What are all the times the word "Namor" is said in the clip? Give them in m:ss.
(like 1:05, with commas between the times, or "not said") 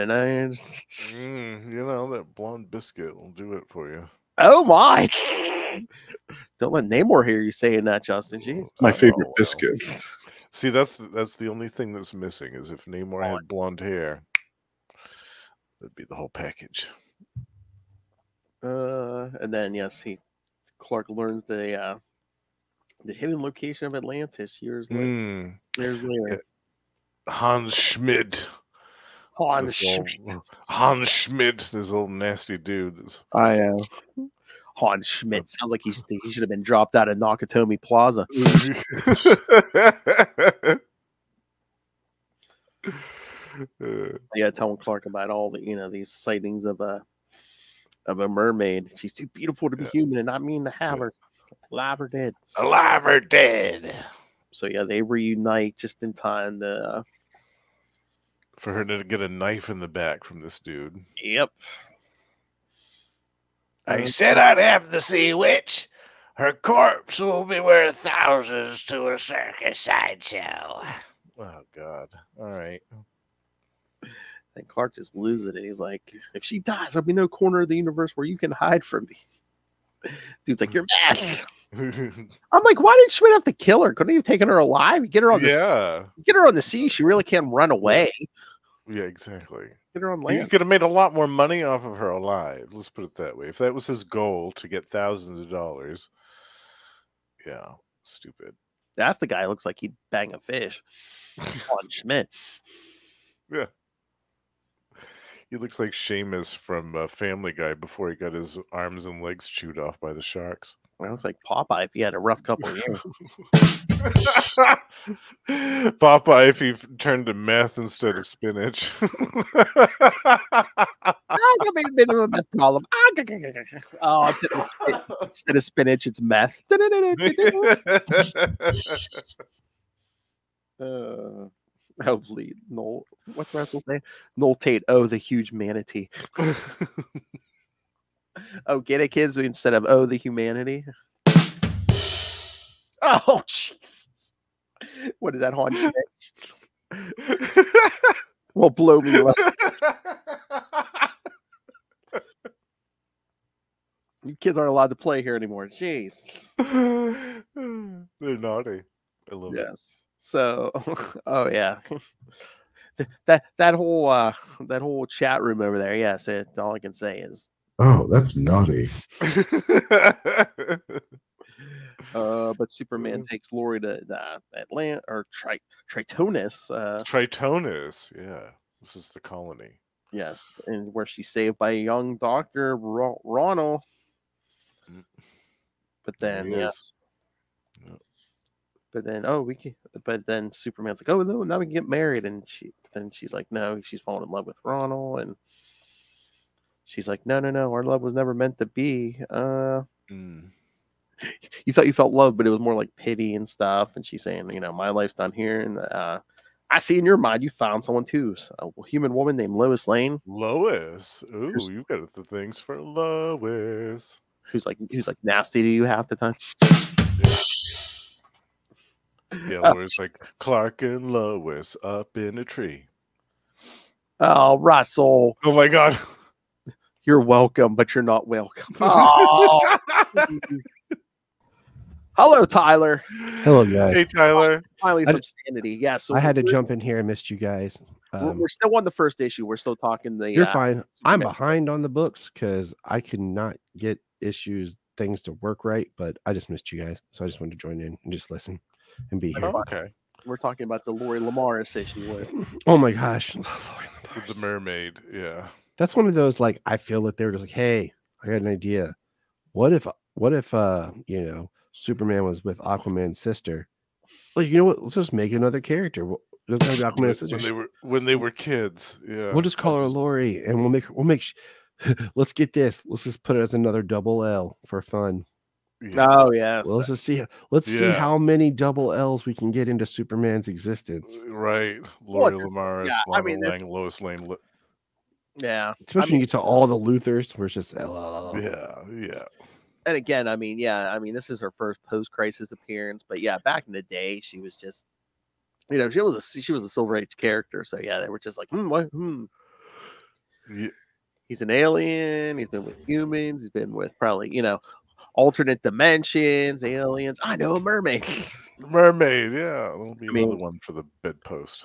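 0:06, 0:12.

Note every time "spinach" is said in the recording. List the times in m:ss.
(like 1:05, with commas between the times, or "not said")
1:58, 2:05.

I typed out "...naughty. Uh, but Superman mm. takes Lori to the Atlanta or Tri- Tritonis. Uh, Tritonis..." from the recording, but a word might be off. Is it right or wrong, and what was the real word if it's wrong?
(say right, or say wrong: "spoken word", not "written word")
right.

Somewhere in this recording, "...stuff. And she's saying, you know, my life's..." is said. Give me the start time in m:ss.
3:23.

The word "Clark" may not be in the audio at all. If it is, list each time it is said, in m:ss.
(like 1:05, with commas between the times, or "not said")
0:20, 0:44, 1:14, 3:40.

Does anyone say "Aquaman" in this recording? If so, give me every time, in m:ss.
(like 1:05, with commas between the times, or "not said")
4:22, 4:26.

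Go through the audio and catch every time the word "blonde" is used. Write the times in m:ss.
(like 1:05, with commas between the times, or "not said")
0:02, 0:13.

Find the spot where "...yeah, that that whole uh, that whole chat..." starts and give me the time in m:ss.
2:41.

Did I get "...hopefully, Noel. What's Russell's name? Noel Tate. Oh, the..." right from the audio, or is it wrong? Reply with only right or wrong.
right.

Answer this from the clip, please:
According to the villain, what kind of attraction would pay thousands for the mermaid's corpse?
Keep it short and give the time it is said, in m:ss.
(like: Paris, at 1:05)
a circus sideshow, at 1:09.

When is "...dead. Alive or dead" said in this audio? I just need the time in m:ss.
0:52.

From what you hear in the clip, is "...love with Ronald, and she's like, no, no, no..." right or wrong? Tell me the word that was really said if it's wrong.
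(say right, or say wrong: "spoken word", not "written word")
right.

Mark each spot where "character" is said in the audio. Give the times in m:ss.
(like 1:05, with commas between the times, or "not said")
4:25, 4:57.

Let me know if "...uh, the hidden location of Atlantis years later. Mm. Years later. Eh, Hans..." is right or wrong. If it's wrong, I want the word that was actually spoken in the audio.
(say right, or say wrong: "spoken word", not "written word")
right.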